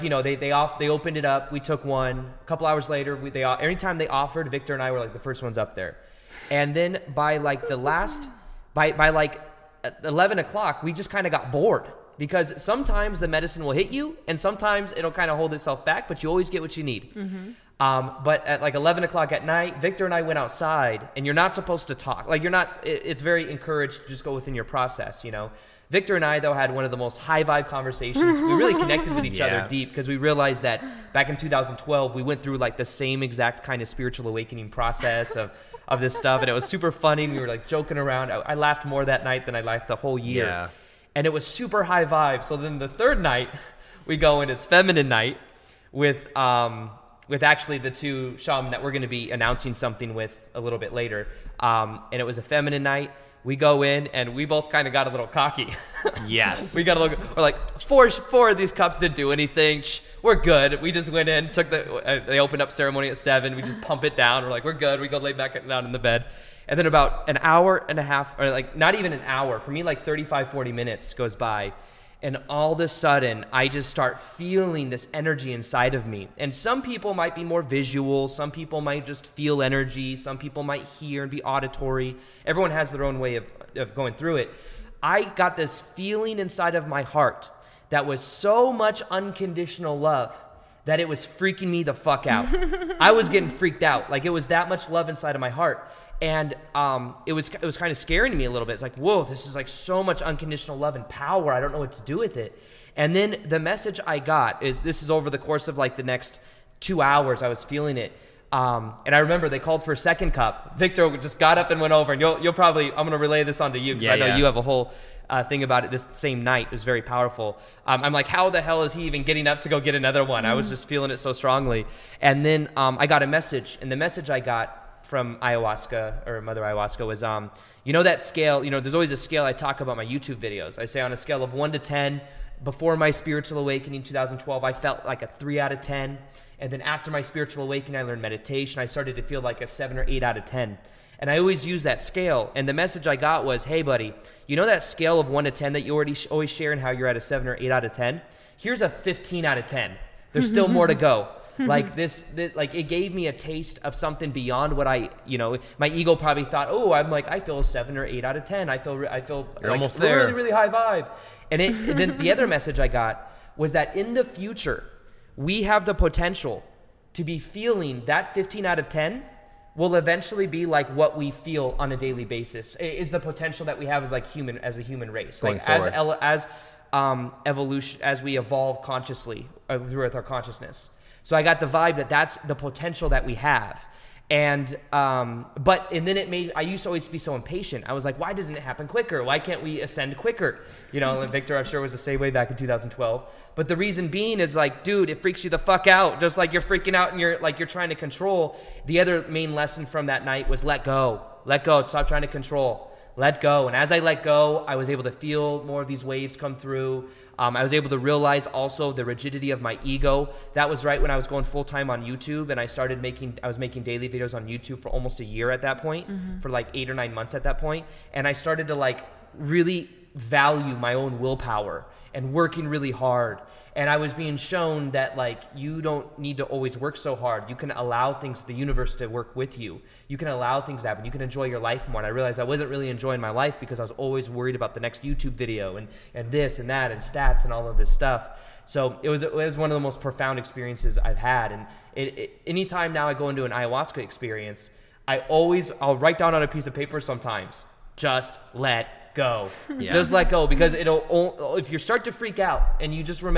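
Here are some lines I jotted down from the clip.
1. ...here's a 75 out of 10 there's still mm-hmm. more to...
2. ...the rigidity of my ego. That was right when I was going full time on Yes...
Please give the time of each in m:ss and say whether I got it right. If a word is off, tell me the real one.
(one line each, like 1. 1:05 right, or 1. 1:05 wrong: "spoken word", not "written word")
1. 2:28 wrong: "15", not "75"
2. 3:28 wrong: "YouTube", not "Yes".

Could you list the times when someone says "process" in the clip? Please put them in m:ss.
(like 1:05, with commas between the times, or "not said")
0:24, 0:34.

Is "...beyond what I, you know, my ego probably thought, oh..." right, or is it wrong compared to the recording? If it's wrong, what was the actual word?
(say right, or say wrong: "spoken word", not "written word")
right.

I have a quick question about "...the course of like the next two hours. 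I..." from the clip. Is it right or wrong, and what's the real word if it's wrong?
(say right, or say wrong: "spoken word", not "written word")
right.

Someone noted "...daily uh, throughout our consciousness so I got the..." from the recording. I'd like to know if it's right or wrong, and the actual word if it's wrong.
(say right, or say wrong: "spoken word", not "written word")
wrong: "consciously", not "daily".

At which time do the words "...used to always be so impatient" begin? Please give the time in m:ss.
3:06.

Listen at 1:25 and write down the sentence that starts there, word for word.
I got this feeling inside of my heart that was so much unconditional love that it was freaking me the fuck out.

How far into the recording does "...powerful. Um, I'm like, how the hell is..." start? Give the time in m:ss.
1:57.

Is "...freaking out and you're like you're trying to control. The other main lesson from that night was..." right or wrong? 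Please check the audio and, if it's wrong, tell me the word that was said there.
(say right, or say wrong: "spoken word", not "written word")
right.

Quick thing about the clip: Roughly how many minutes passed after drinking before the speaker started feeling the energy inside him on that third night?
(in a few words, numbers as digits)
35 to 40 minutes.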